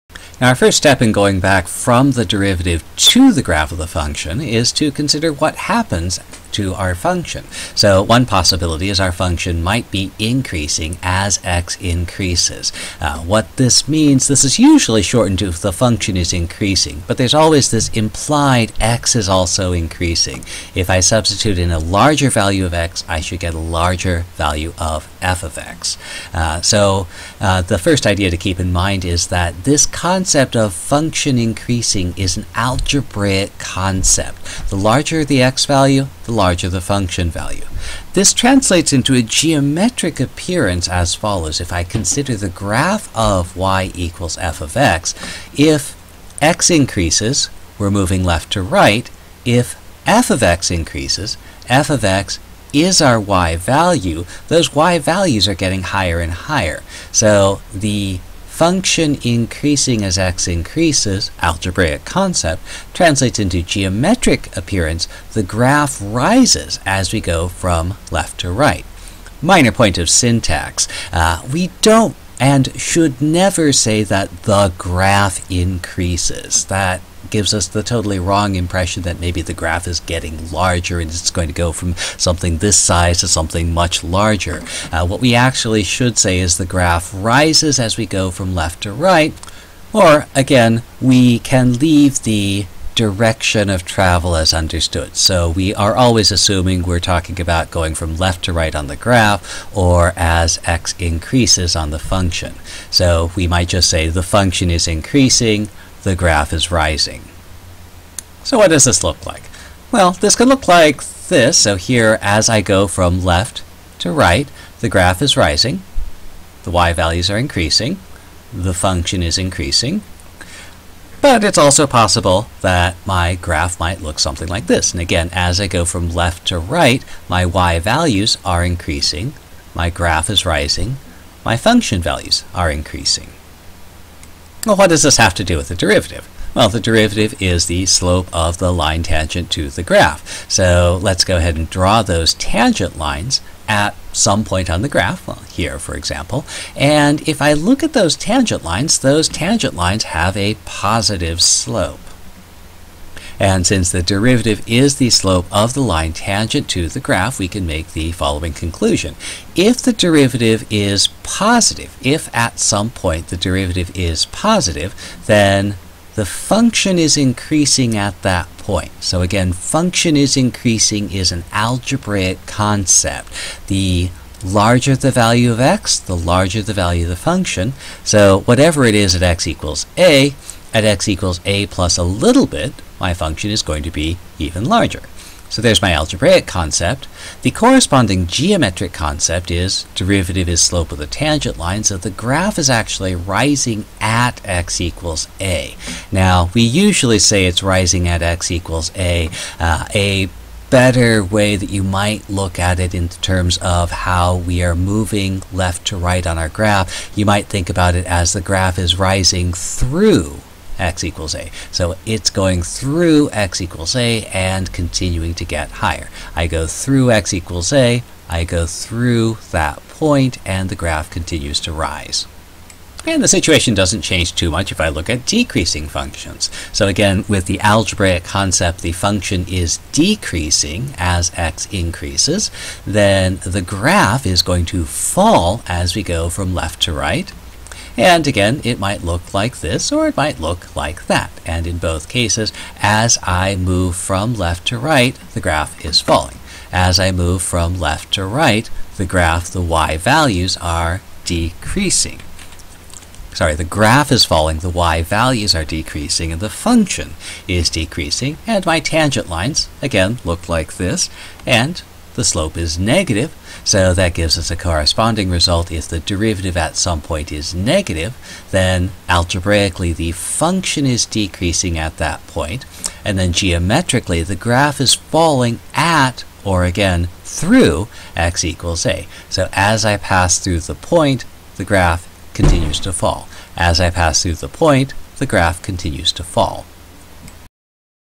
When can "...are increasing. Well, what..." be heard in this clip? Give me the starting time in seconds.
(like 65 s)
132 s.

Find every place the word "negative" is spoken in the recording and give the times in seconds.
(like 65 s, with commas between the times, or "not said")
262 s, 267 s.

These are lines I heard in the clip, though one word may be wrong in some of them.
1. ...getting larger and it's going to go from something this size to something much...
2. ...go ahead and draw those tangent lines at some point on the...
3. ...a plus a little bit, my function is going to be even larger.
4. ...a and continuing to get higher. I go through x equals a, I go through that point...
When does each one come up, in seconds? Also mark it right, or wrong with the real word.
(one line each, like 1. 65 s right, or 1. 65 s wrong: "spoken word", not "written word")
1. 80 s right
2. 141 s right
3. 181 s right
4. 213 s right.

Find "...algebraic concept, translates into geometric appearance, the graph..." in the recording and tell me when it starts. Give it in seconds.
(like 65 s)
61 s.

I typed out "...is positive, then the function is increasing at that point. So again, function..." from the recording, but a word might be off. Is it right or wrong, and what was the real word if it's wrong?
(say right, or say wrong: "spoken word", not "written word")
right.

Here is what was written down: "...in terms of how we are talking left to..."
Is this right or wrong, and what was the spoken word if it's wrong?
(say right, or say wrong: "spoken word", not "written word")
wrong: "moving", not "talking".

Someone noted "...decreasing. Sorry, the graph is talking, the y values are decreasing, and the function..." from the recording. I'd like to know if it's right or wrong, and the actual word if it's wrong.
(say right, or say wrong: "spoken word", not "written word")
wrong: "falling", not "talking".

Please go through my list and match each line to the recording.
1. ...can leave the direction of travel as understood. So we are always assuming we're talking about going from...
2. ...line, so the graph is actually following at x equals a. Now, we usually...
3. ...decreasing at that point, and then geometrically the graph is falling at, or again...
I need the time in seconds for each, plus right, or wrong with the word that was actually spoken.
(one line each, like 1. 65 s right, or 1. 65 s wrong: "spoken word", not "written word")
1. 91 s right
2. 191 s wrong: "rising", not "following"
3. 271 s right.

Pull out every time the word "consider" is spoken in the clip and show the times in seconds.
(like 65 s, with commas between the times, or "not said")
4 s, 41 s.